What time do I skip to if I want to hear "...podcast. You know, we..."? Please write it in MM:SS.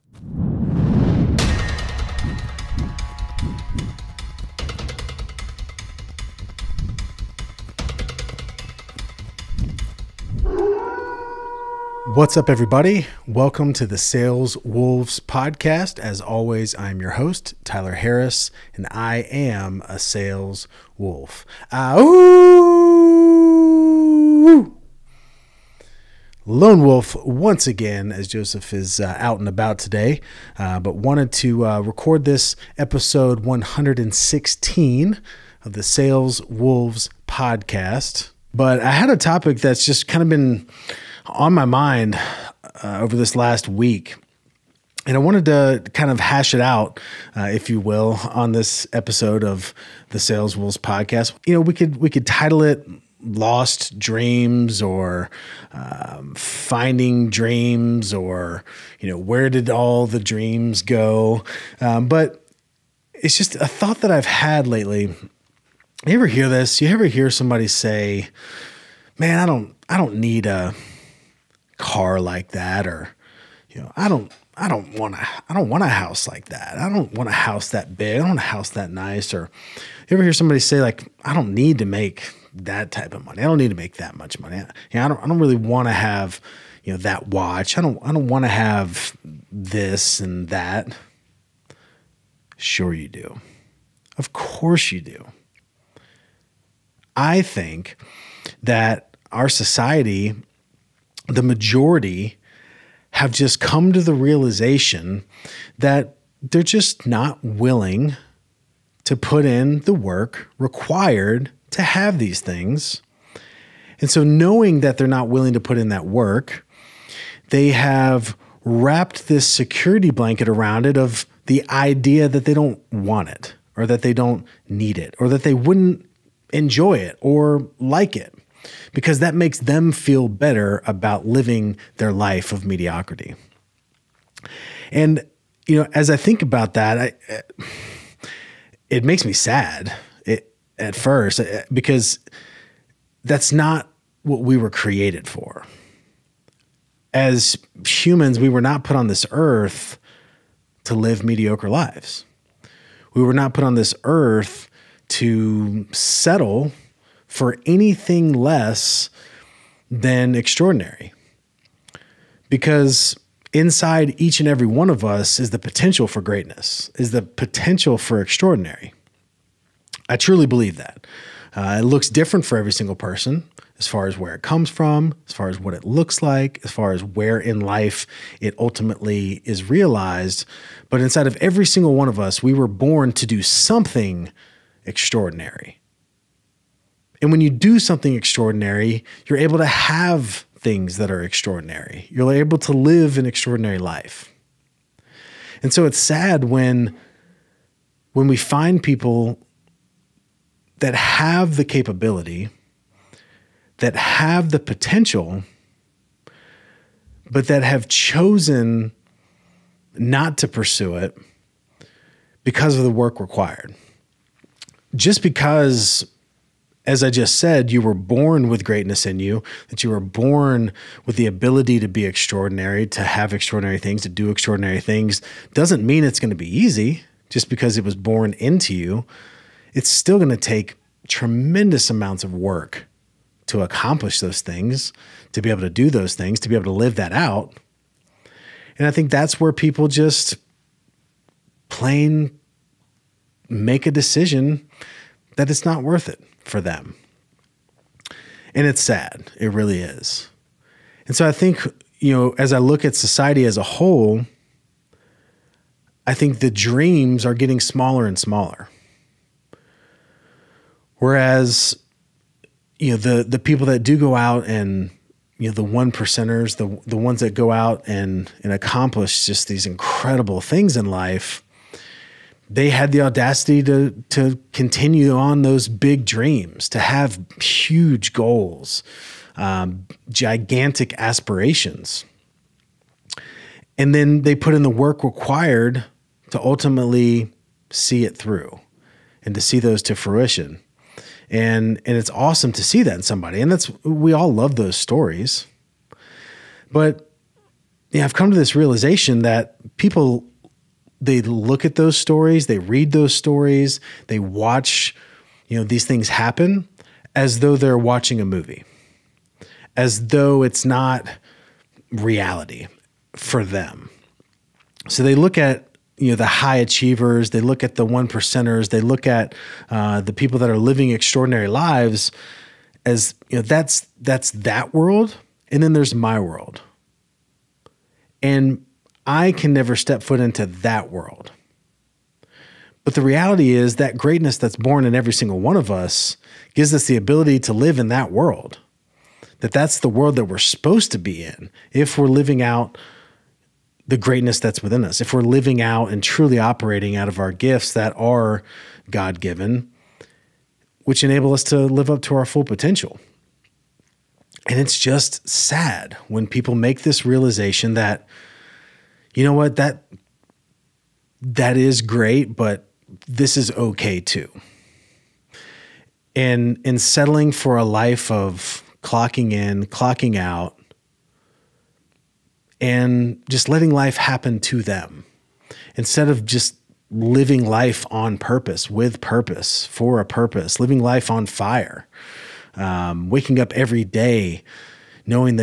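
00:50.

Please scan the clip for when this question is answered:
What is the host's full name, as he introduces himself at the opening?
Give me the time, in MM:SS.
00:17.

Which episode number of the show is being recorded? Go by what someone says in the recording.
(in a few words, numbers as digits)
116.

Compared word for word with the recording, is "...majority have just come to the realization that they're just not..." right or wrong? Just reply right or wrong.
right.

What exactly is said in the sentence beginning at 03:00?
But inside of every single one of us, we were born to do something extraordinary.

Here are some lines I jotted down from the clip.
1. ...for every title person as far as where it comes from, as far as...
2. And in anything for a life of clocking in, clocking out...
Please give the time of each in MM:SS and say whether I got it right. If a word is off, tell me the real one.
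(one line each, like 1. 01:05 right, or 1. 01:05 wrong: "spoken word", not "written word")
1. 02:52 wrong: "single", not "title"
2. 06:06 wrong: "settling", not "anything".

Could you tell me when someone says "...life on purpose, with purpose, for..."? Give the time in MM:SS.
06:17.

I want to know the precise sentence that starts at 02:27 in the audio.
As humans, we were not put on this earth to live mediocre lives.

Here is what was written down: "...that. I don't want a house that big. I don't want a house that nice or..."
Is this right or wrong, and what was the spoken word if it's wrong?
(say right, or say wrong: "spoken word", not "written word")
right.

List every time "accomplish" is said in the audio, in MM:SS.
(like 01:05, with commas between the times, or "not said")
03:53, 04:28.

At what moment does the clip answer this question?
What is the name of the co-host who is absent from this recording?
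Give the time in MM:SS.
00:28.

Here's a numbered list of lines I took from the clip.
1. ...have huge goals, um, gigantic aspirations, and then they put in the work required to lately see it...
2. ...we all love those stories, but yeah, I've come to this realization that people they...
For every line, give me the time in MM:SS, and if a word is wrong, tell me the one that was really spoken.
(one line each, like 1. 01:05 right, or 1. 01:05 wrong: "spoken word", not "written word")
1. 04:36 wrong: "ultimately", not "lately"
2. 04:53 right.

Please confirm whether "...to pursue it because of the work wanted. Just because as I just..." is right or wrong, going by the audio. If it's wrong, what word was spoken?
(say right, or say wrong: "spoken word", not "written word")
wrong: "required", not "wanted".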